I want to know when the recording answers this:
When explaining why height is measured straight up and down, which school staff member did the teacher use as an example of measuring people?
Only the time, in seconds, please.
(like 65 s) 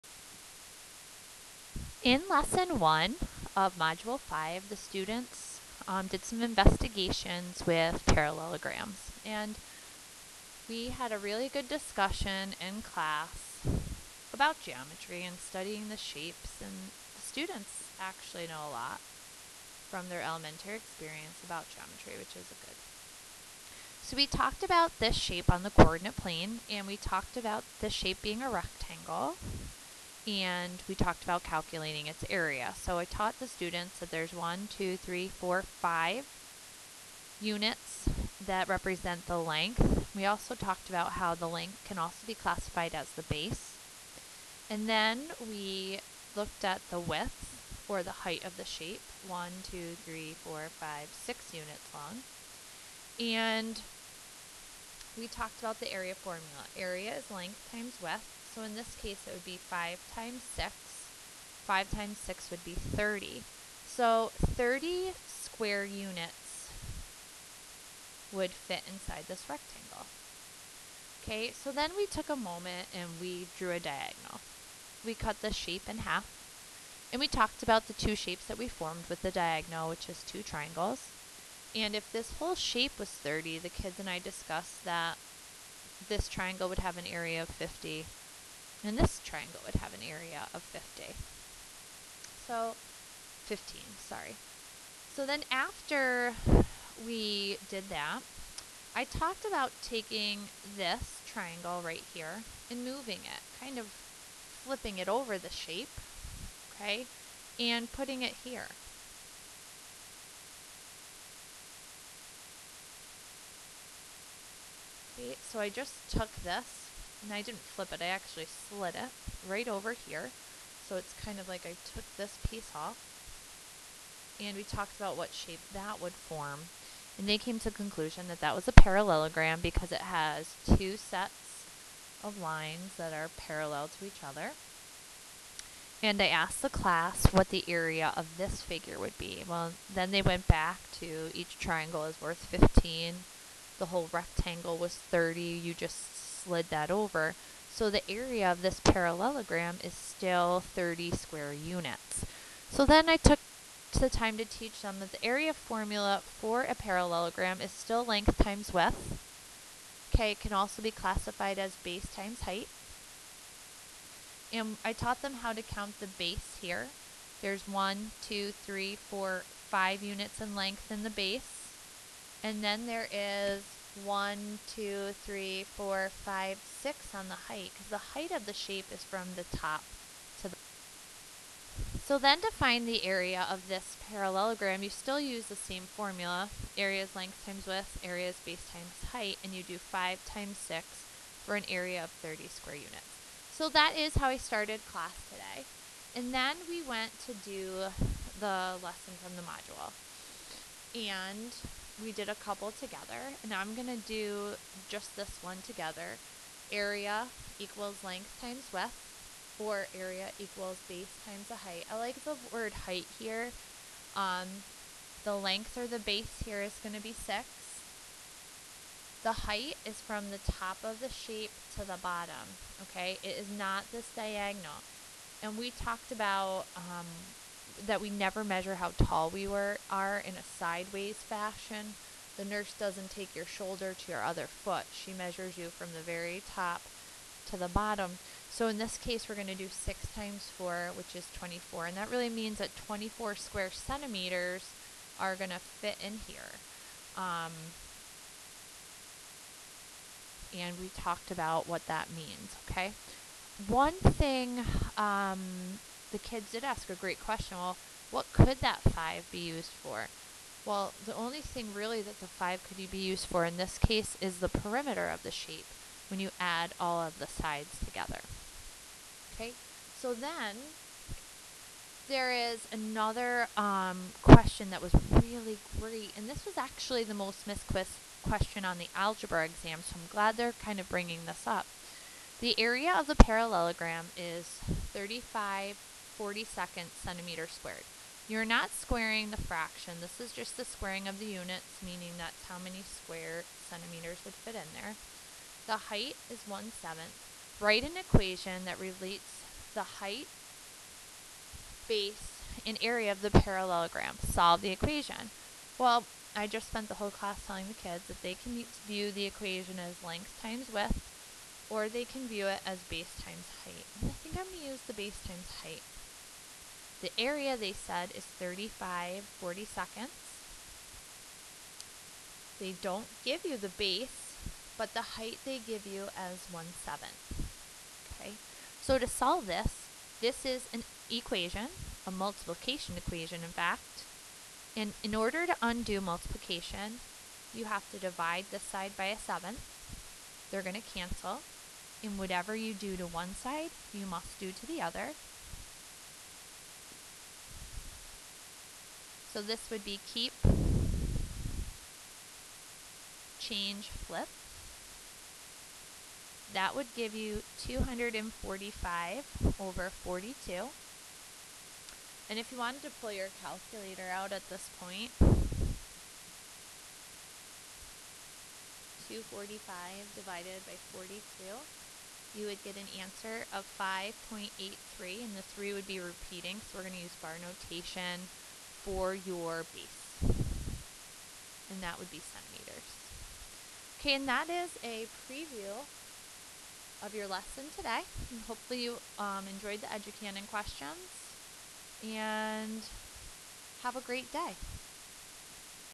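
232 s.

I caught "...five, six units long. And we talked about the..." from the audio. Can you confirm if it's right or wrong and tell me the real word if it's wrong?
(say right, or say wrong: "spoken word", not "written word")
right.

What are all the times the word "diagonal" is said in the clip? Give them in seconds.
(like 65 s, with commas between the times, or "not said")
73 s, 79 s, 224 s.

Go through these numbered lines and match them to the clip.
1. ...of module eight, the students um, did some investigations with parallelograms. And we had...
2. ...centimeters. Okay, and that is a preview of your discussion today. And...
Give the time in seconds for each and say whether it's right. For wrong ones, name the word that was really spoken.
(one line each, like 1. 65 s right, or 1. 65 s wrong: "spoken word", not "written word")
1. 3 s wrong: "five", not "eight"
2. 382 s wrong: "lesson", not "discussion".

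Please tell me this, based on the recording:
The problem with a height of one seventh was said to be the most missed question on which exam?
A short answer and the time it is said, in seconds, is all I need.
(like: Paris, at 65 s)
the algebra exam, at 278 s.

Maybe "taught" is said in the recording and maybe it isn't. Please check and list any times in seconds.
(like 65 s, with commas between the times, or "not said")
33 s, 164 s.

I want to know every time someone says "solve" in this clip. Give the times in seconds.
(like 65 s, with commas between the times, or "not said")
304 s, 329 s.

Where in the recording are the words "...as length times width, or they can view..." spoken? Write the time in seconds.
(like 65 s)
309 s.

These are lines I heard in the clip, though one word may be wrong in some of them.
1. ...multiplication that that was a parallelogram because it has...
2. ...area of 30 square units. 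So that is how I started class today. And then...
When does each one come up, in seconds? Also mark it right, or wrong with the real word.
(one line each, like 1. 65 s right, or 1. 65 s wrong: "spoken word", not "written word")
1. 127 s wrong: "conclusion", not "multiplication"
2. 191 s right.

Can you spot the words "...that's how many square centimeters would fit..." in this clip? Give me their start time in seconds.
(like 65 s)
292 s.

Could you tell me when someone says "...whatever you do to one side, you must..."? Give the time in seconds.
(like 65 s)
342 s.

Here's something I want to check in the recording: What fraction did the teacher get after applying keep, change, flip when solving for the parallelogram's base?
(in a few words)
245/42.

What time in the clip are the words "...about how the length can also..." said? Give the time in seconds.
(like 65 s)
40 s.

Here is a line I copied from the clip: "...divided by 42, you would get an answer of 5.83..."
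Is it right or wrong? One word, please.
right.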